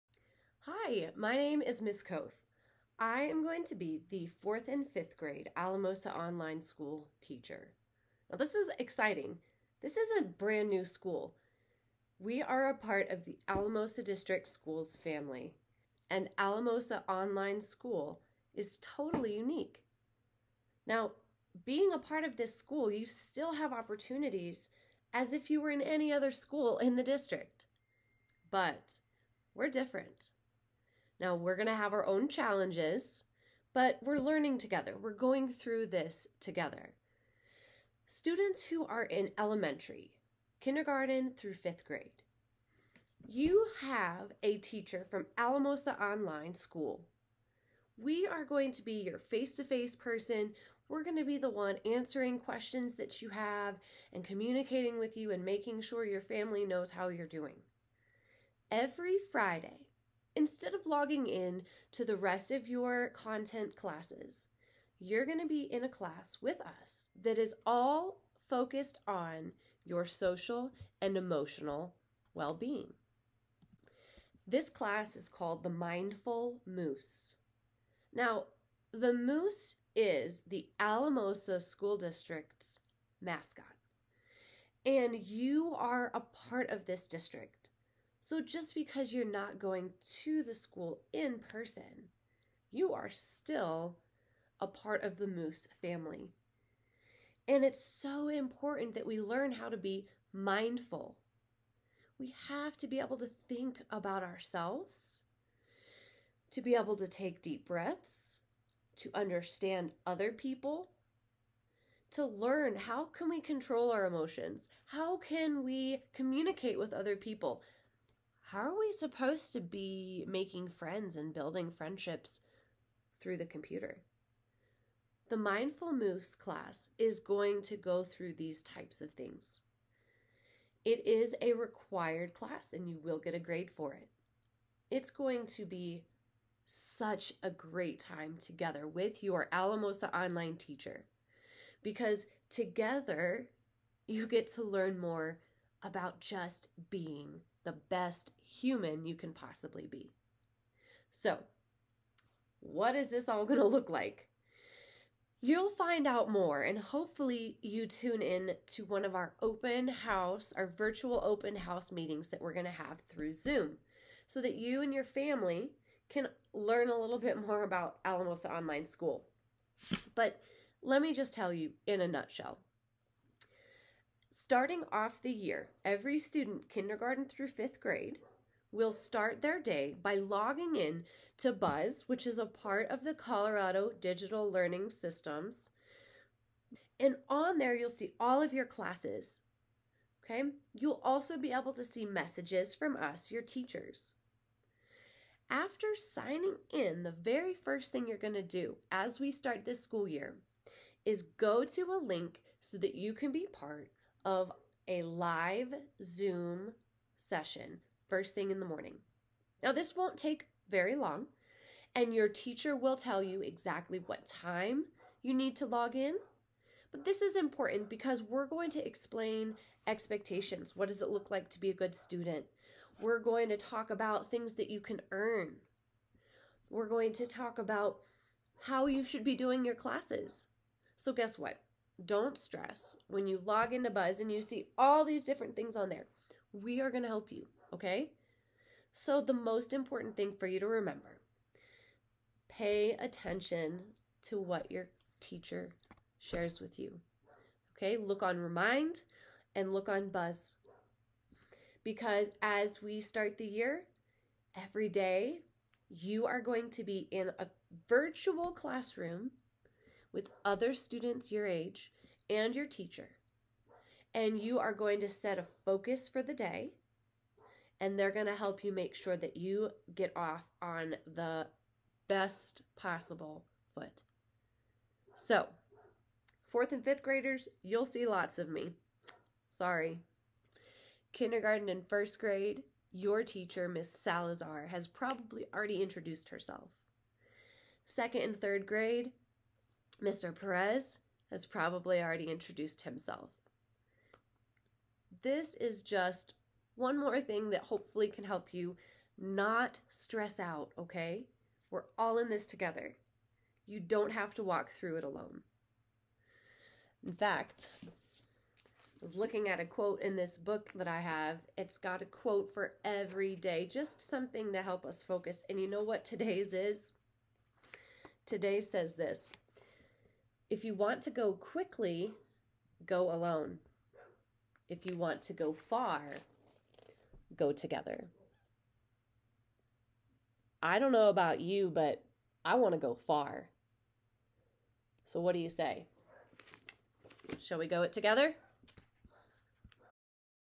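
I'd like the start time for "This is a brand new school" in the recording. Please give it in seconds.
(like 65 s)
9 s.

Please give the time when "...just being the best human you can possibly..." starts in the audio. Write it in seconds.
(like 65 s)
146 s.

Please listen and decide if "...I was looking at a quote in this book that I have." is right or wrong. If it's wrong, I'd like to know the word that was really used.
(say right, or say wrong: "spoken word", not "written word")
right.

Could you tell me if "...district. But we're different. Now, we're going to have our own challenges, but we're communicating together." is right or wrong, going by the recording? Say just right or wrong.
wrong.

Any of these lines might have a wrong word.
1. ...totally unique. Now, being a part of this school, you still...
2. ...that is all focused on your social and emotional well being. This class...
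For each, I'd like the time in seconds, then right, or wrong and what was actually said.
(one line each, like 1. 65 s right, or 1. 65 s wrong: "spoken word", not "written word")
1. 18 s right
2. 67 s right.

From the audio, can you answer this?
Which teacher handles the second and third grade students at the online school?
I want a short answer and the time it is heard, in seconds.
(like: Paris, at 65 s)
Mr. Perez, at 290 s.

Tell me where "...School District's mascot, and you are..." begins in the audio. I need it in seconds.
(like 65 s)
81 s.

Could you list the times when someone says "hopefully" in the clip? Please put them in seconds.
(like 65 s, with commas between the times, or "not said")
156 s, 297 s.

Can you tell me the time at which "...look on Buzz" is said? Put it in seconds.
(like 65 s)
249 s.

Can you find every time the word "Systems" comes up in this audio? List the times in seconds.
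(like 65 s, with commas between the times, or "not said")
184 s.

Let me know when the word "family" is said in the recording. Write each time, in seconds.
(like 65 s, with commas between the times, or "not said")
14 s, 56 s, 95 s, 165 s.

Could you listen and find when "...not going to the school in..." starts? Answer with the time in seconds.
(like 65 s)
89 s.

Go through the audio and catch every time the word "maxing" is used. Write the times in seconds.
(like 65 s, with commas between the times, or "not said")
not said.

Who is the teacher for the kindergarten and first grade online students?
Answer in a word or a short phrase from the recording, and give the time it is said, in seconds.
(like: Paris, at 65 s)
Miss Salazar, at 283 s.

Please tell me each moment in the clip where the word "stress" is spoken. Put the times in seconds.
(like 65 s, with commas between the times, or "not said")
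232 s, 299 s.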